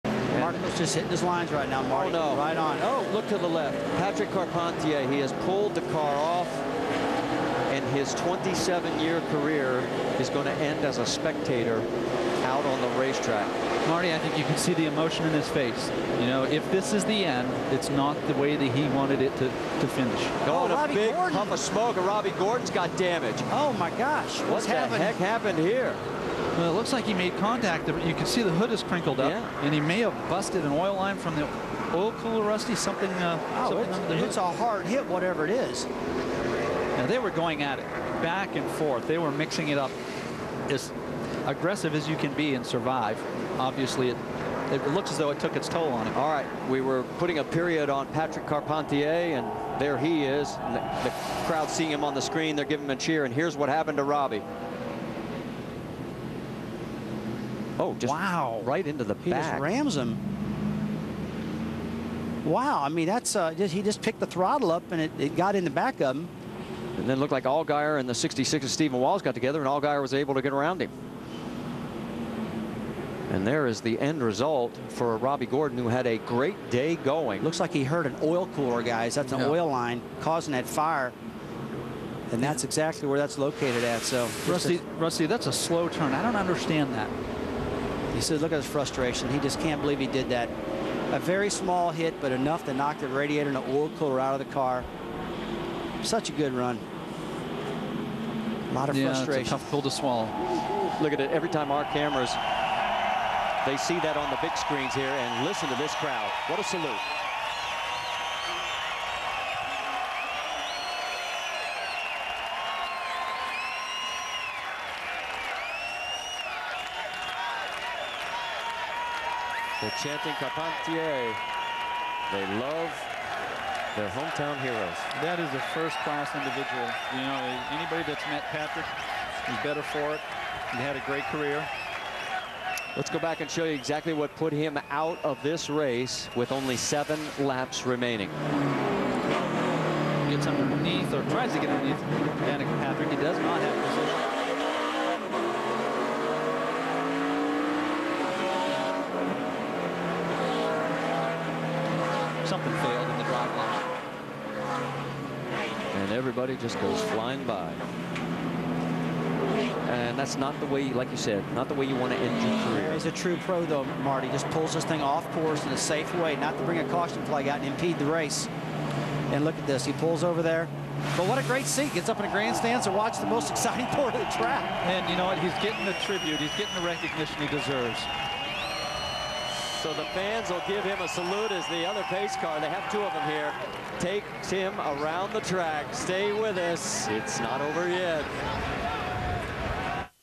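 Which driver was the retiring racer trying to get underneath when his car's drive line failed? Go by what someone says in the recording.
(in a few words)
Danica Patrick.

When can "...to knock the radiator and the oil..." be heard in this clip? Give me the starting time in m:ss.
1:32.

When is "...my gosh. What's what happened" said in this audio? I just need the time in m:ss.
0:23.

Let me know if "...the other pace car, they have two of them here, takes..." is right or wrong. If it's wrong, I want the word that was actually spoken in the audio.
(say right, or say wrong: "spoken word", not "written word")
right.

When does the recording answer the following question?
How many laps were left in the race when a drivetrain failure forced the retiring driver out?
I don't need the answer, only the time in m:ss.
2:16.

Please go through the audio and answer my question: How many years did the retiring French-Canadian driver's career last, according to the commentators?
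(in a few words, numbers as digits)
27.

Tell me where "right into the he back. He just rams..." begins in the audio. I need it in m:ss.
0:58.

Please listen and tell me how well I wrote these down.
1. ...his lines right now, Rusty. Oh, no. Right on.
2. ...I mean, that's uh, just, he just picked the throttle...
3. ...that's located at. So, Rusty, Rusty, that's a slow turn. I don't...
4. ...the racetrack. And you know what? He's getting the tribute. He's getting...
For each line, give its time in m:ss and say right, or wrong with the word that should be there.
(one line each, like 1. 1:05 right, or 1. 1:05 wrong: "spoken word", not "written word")
1. 0:01 wrong: "Marty", not "Rusty"
2. 1:02 right
3. 1:23 right
4. 2:54 wrong: "track", not "racetrack".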